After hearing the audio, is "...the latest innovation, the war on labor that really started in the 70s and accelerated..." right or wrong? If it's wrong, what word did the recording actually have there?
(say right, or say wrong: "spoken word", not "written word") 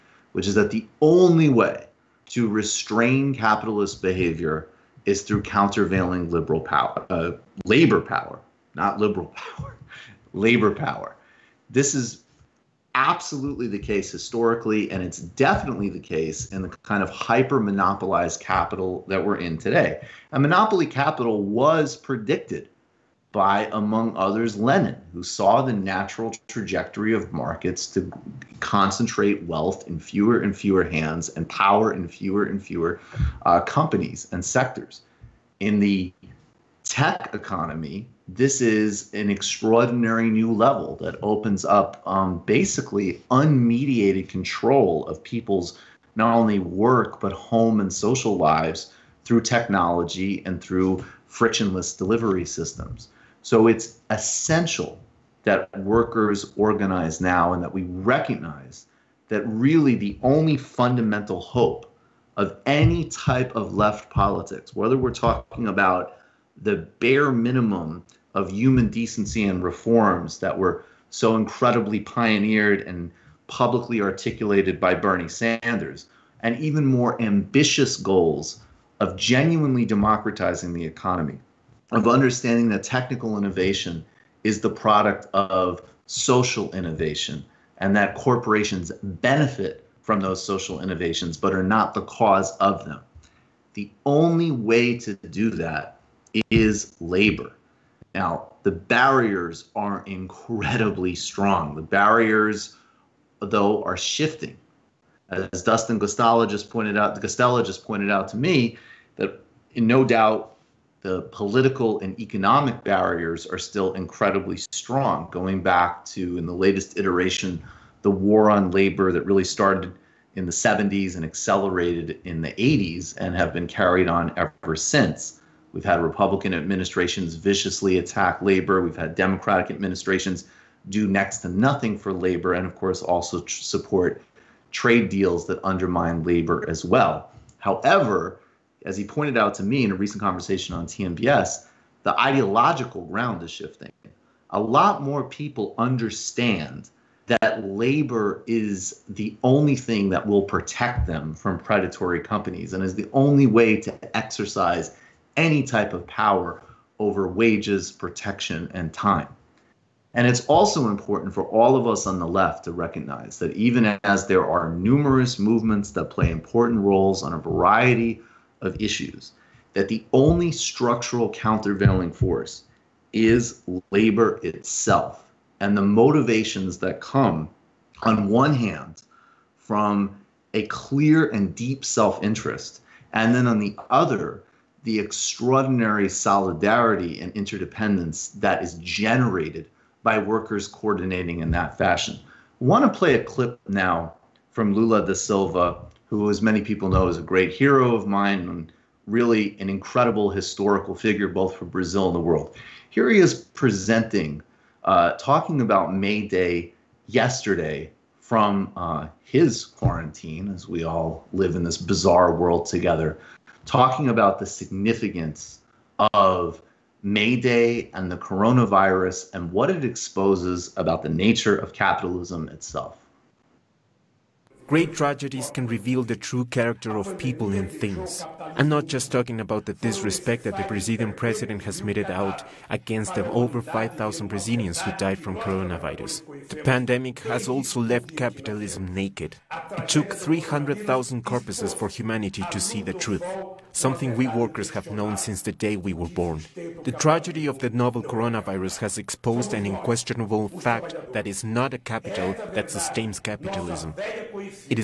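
wrong: "iteration", not "innovation".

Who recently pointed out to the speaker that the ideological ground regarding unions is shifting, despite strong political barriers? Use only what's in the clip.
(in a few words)
Dustin Guastella.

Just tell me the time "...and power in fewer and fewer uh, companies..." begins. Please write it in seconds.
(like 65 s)
31 s.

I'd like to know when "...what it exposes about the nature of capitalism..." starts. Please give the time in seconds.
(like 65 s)
219 s.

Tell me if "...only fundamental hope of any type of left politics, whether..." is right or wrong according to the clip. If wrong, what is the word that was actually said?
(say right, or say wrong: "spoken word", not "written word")
right.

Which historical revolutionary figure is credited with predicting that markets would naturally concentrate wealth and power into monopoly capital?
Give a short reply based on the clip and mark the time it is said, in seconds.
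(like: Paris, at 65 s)
Lenin, at 24 s.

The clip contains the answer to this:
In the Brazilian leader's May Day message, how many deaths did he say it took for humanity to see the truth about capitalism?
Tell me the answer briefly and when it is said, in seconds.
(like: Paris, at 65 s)
300,000, at 240 s.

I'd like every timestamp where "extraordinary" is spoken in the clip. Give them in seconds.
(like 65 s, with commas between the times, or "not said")
39 s, 184 s.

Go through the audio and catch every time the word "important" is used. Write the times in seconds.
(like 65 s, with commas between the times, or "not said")
160 s, 166 s.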